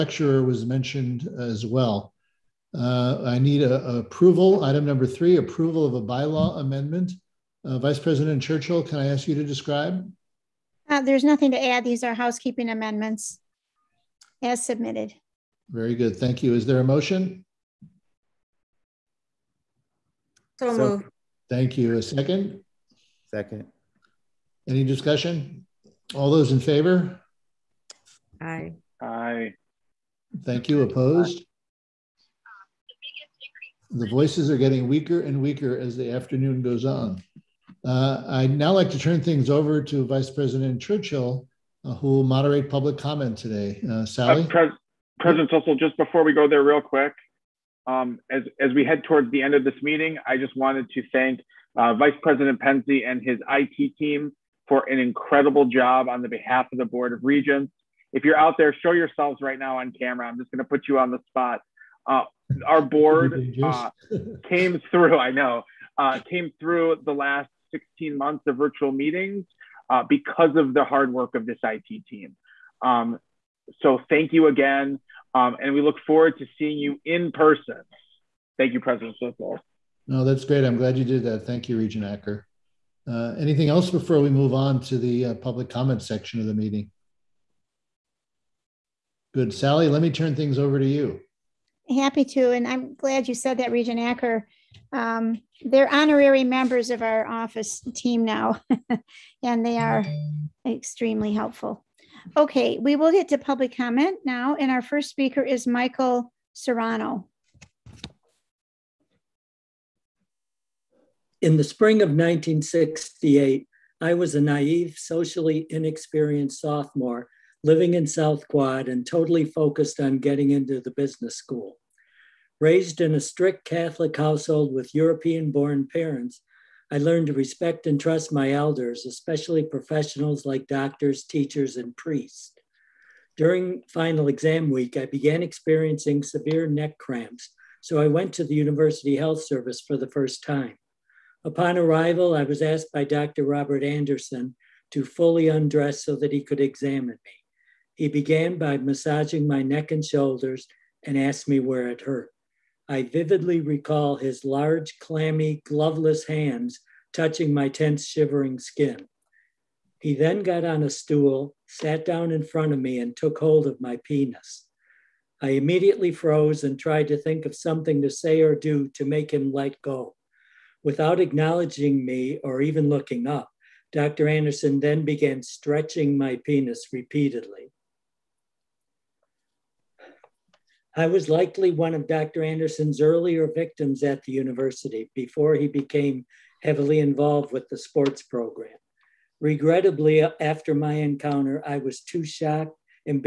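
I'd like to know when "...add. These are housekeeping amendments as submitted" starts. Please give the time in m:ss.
0:11.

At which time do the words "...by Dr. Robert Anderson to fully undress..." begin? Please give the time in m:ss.
2:22.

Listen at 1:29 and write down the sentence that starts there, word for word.
Sally, let me turn things over to you.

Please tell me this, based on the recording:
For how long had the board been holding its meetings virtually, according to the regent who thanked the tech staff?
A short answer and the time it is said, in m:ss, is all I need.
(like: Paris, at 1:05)
16 months, at 1:07.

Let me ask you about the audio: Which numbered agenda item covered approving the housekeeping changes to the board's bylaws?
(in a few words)
3.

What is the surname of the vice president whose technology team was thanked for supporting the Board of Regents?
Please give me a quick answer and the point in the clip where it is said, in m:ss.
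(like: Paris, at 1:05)
Pendse, at 0:52.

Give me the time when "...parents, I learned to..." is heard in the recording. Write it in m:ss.
2:05.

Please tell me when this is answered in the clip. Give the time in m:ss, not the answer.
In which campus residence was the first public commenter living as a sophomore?
1:58.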